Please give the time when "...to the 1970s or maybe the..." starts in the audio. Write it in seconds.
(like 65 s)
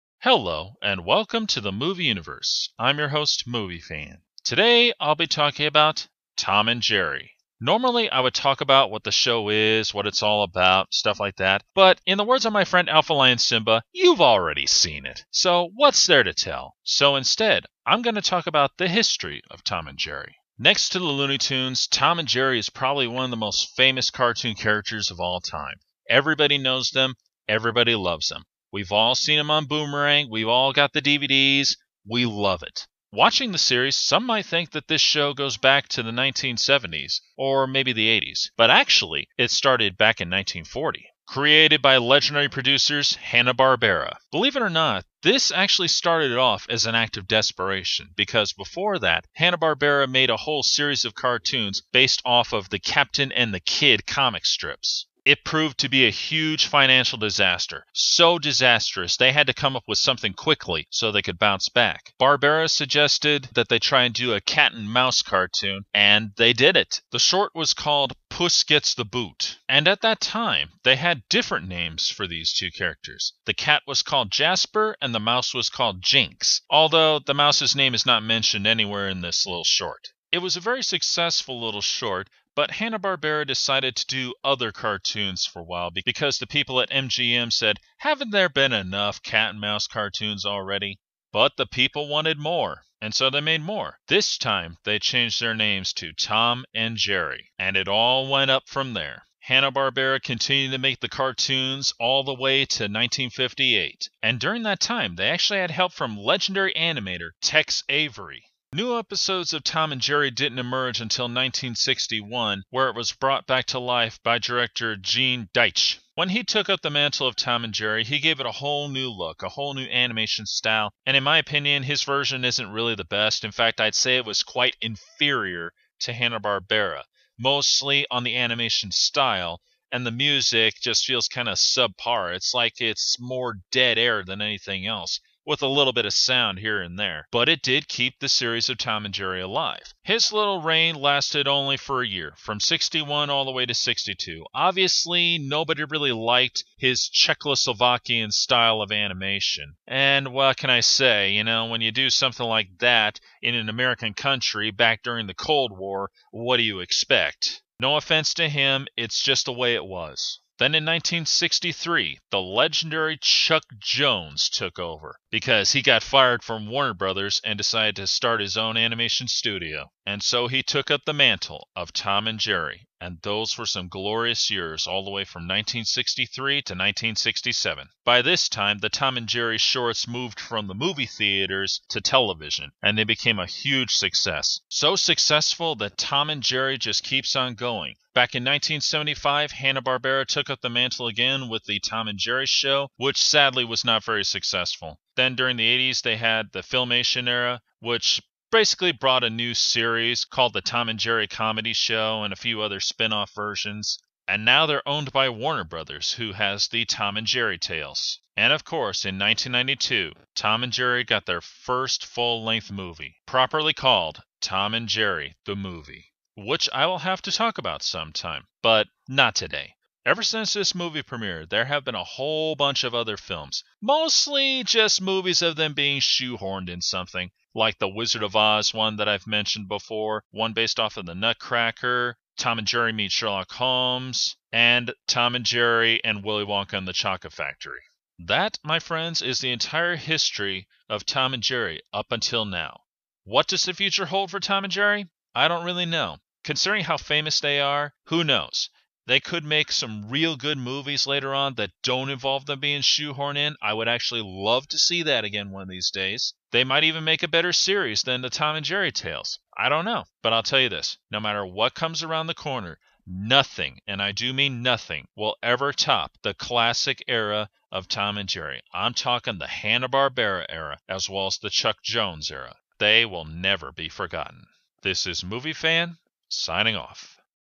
35 s.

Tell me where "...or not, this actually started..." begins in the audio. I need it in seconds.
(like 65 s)
44 s.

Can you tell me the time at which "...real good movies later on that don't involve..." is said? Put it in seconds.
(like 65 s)
250 s.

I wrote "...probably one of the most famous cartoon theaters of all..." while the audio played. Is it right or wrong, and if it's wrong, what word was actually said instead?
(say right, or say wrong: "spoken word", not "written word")
wrong: "characters", not "theaters".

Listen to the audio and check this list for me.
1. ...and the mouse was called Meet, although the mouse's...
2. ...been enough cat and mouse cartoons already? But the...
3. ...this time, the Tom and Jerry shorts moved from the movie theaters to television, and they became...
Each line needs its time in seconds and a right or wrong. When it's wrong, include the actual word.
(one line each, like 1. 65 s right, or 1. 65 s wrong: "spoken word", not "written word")
1. 75 s wrong: "Jinx", not "Meet"
2. 88 s right
3. 178 s right.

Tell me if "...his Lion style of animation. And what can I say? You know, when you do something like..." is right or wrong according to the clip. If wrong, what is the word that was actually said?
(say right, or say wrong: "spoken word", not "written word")
wrong: "Czechoslovakian", not "Lion".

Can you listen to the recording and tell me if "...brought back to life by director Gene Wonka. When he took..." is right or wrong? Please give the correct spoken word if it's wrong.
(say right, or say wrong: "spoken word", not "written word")
wrong: "Deitch", not "Wonka".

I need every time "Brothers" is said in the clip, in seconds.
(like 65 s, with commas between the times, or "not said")
166 s, 205 s.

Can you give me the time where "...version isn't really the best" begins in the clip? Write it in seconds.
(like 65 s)
122 s.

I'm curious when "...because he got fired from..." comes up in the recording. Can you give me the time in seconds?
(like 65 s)
165 s.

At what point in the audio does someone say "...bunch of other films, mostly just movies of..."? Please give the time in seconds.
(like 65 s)
222 s.